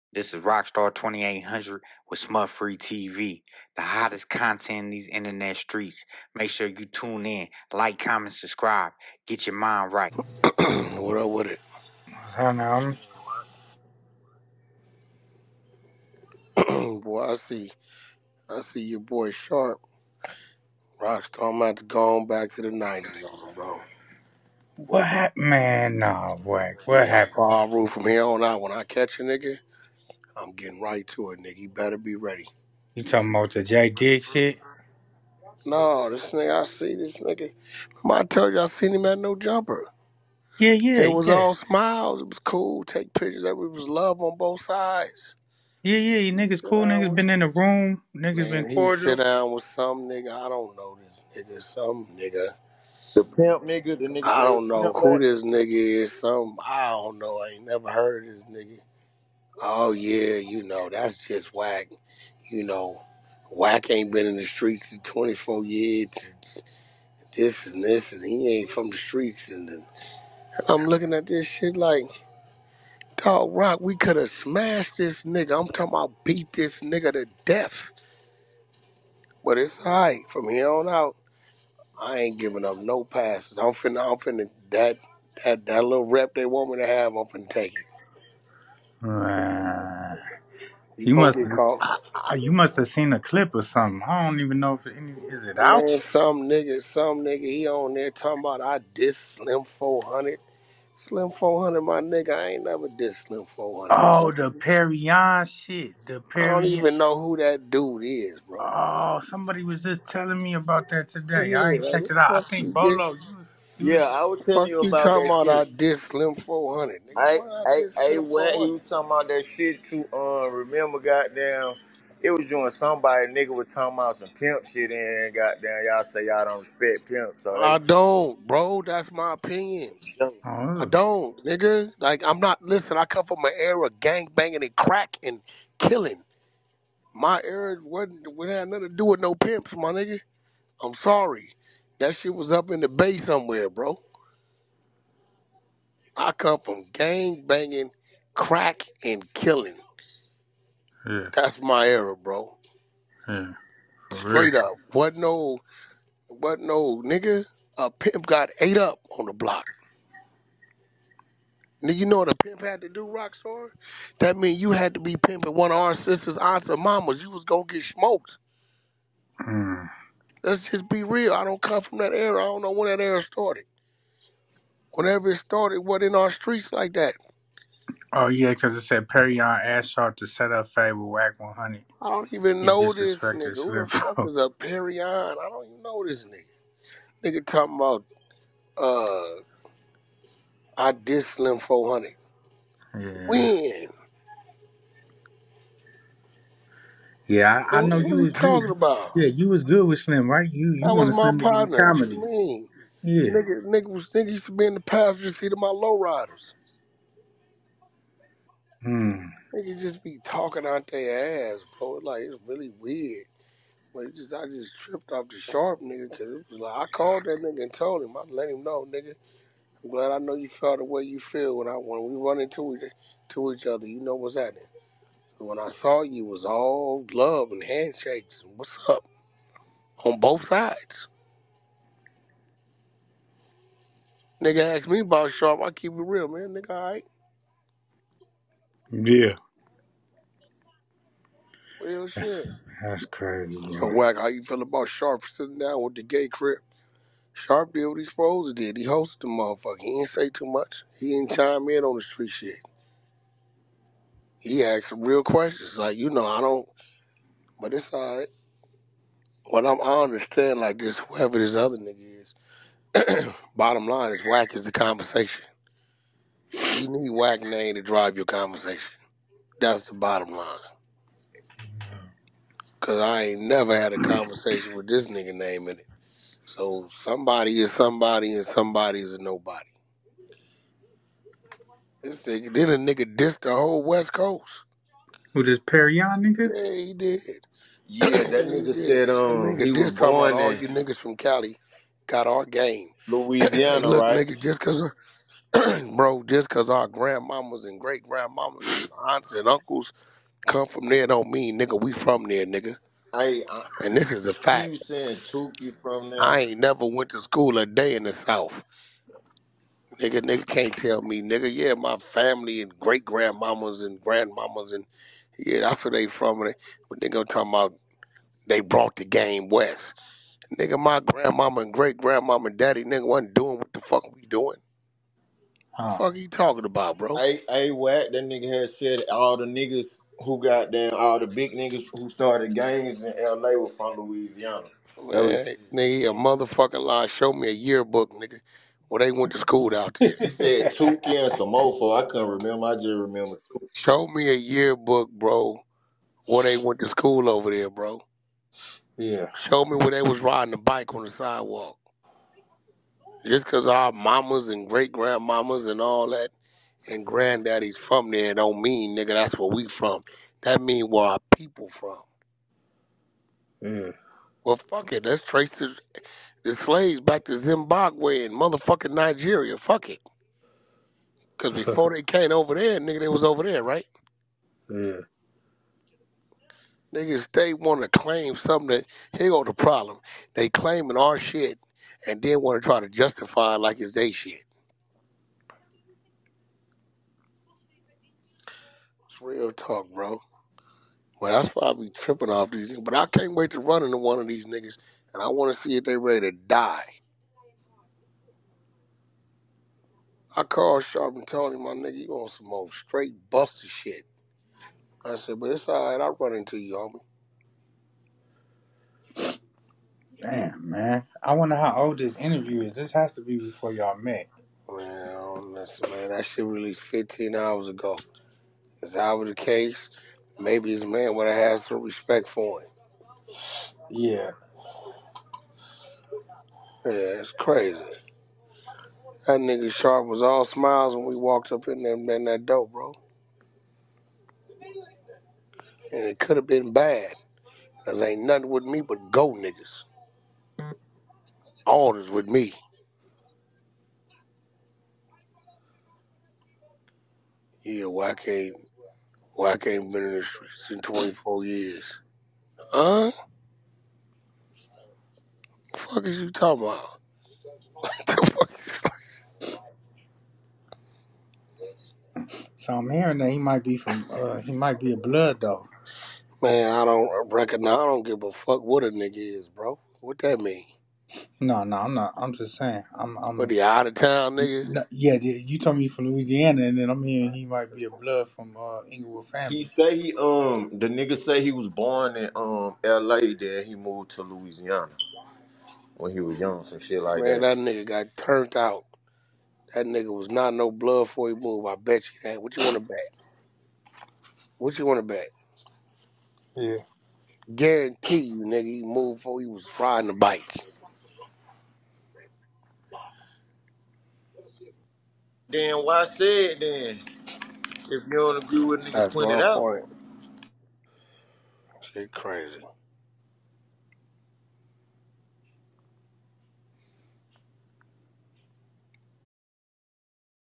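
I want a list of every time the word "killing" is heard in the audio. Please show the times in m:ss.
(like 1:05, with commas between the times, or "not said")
2:15, 2:29.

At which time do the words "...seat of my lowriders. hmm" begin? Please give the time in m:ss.
3:25.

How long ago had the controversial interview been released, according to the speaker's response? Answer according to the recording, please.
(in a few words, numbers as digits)
15 hours.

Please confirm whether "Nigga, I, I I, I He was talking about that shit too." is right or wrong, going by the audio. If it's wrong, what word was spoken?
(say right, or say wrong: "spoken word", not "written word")
right.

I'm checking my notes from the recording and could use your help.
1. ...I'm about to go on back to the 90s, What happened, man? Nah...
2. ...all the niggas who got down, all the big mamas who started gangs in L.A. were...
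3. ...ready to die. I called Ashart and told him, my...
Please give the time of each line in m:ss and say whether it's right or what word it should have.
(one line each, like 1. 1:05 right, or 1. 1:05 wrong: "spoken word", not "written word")
1. 0:21 right
2. 5:29 wrong: "niggas", not "mamas"
3. 6:35 wrong: "Sharp", not "Ashart".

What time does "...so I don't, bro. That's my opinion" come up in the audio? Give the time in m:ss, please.
2:07.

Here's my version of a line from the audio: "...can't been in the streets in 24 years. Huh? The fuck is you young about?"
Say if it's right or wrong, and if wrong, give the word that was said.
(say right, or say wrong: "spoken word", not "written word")
wrong: "talking", not "young".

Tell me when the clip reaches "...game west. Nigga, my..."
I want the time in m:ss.
5:19.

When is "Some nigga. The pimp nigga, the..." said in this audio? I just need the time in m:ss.
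0:51.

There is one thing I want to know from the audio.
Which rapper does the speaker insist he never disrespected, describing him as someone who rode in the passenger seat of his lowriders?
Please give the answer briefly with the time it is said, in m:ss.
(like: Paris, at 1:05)
Slim 400, at 1:40.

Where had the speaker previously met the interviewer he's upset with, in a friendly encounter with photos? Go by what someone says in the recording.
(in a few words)
No Jumper.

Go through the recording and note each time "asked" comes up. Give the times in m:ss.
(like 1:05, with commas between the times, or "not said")
3:54, 4:14.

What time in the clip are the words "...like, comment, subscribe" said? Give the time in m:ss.
0:07.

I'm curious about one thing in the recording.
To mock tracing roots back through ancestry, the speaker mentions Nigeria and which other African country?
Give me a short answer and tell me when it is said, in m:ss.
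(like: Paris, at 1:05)
Zimbabwe, at 6:07.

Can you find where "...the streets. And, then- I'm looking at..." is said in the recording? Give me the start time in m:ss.
1:08.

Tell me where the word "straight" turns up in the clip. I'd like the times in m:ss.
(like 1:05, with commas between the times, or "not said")
2:34, 6:42.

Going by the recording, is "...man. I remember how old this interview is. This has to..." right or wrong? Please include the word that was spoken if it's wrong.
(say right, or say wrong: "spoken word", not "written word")
wrong: "wonder", not "remember".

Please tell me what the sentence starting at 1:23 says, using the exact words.
I'm finna, I'm finna that that that little rep they want me to have.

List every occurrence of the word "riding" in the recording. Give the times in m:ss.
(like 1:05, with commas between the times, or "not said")
5:50, 8:19.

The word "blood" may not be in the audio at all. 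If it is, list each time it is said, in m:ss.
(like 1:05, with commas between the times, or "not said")
7:44, 7:57, 8:10.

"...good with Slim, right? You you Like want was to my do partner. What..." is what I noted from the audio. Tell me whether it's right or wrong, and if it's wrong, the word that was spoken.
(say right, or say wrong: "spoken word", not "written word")
wrong: "That", not "Like".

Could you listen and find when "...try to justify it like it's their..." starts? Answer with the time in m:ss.
6:22.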